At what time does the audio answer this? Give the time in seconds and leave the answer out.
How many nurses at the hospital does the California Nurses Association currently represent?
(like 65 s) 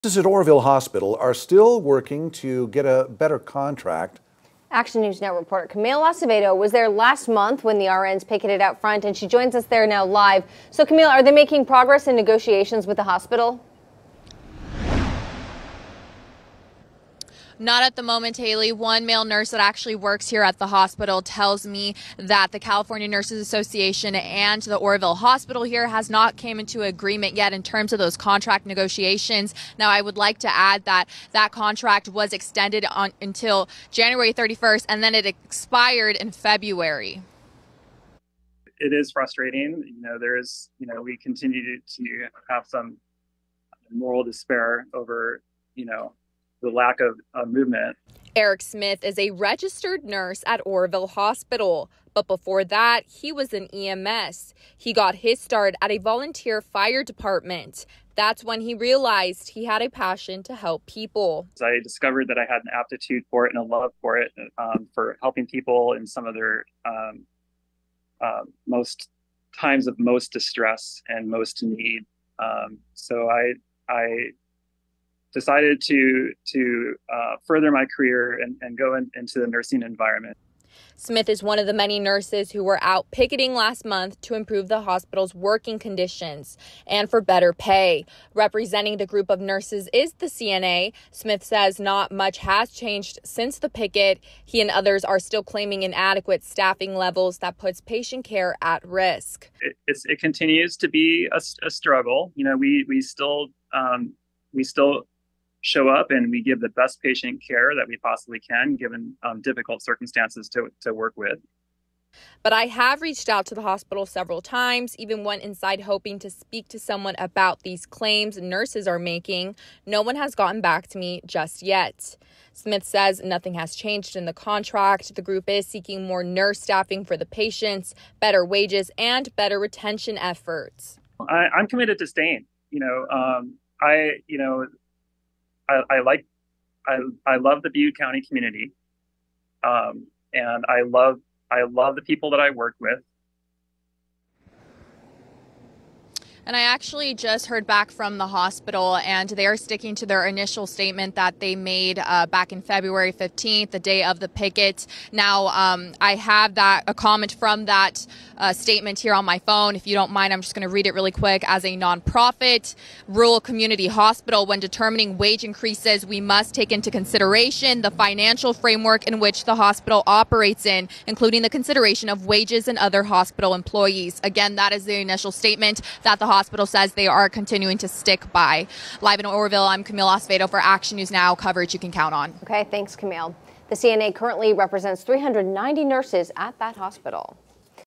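185 s.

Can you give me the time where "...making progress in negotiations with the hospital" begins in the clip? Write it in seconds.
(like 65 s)
11 s.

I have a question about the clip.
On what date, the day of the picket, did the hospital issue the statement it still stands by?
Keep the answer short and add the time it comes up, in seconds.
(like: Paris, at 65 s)
February 15th, at 152 s.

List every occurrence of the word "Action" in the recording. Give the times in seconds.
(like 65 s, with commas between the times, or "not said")
4 s, 180 s.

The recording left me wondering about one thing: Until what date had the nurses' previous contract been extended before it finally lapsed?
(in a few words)
January 31st.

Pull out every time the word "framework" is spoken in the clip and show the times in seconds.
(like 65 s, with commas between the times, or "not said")
168 s.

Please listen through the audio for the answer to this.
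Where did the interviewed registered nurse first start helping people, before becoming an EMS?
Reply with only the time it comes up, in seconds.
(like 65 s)
55 s.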